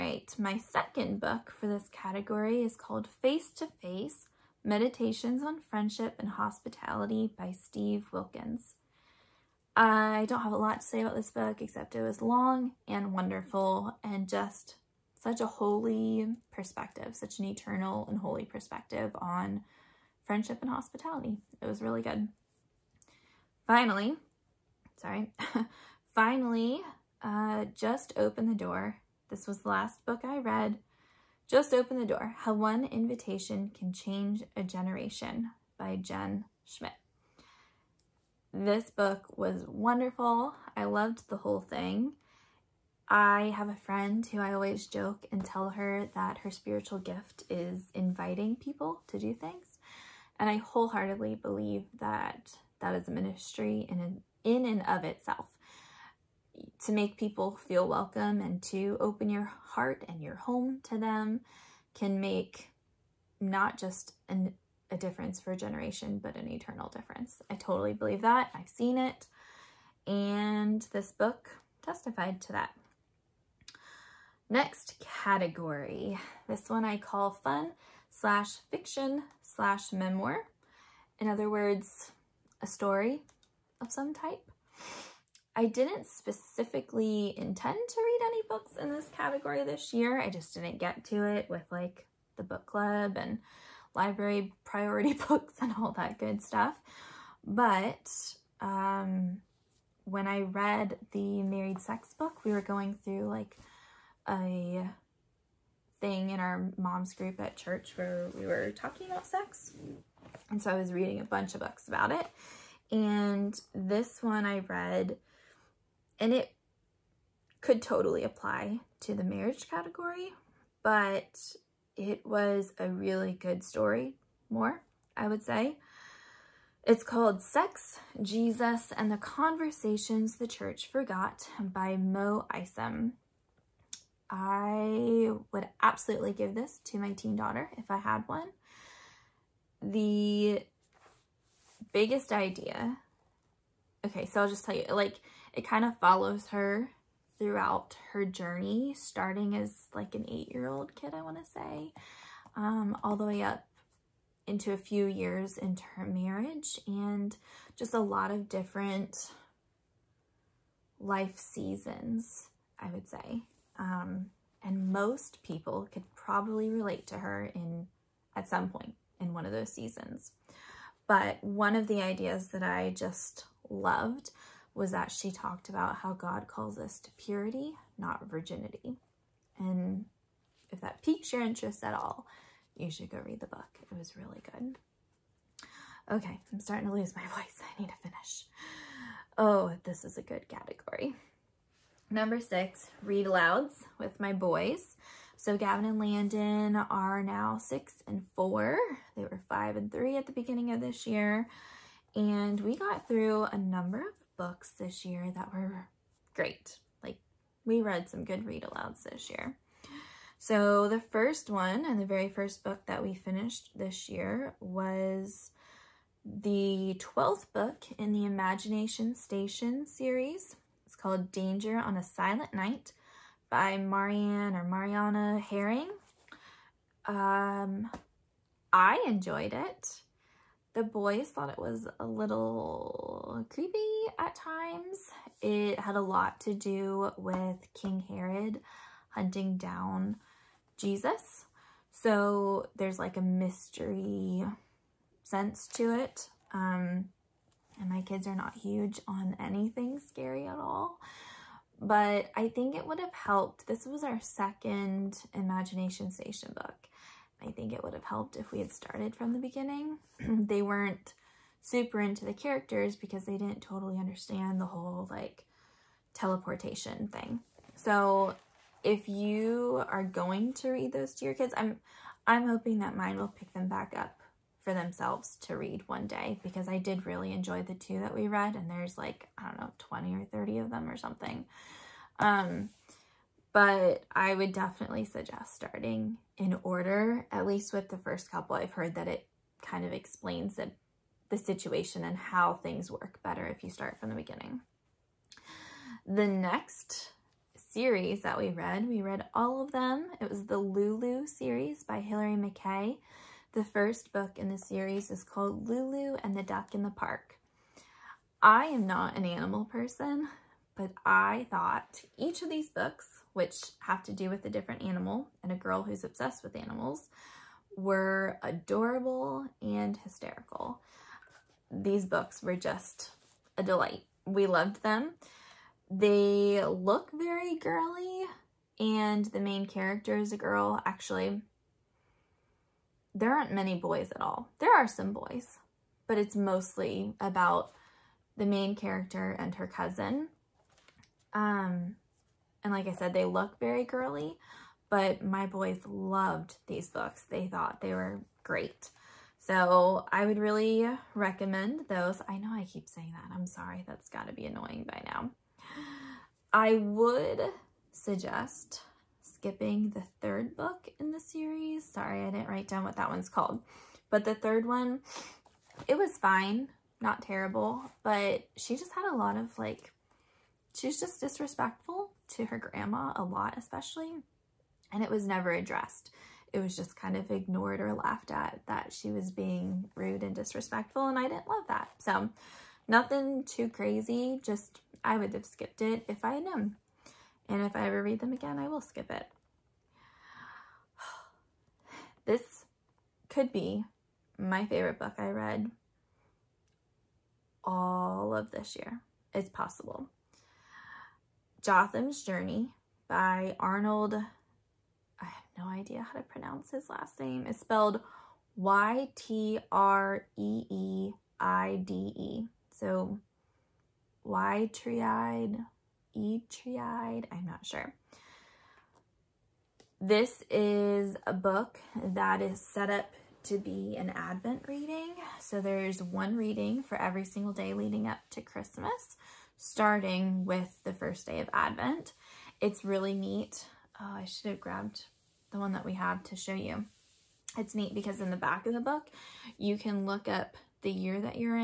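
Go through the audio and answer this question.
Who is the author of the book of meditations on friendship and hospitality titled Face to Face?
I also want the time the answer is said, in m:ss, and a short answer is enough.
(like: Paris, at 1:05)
Steve Wilkins, at 0:07.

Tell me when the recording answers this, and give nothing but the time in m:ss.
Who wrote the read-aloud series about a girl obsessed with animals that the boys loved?
5:01.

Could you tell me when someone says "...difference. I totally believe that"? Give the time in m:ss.
1:06.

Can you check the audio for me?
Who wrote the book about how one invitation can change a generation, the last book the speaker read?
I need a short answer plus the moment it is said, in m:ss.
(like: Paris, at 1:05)
Jen Schmidt, at 0:35.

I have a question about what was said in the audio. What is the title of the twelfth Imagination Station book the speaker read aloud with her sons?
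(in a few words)
Danger on a Silent Night.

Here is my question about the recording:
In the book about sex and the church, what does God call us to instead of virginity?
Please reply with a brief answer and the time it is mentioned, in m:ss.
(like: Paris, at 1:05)
purity, at 2:57.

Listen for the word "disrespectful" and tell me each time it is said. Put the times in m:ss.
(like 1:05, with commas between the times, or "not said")
6:11, 6:20.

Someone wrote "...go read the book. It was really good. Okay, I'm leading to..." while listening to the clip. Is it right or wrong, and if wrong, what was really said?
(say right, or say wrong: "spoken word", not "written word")
wrong: "starting", not "leading".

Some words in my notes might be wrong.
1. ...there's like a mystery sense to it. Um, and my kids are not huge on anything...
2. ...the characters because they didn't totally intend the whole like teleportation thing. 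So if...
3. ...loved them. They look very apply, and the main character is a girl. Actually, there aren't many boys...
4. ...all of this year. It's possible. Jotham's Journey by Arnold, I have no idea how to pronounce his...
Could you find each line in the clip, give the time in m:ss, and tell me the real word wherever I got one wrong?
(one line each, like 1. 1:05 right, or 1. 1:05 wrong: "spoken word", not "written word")
1. 4:02 right
2. 4:22 wrong: "understand", not "intend"
3. 5:24 wrong: "girly", not "apply"
4. 6:37 right.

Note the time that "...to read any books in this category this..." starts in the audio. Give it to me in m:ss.
1:27.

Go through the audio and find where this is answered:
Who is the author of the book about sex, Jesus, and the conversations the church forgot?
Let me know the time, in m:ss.
2:11.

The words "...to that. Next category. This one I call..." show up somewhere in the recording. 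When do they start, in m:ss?
1:12.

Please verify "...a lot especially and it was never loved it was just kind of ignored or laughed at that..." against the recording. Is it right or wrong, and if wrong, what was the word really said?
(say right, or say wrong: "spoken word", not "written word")
wrong: "addressed", not "loved".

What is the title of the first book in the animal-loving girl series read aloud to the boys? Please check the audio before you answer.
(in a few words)
Lulu and the Duck in the Park.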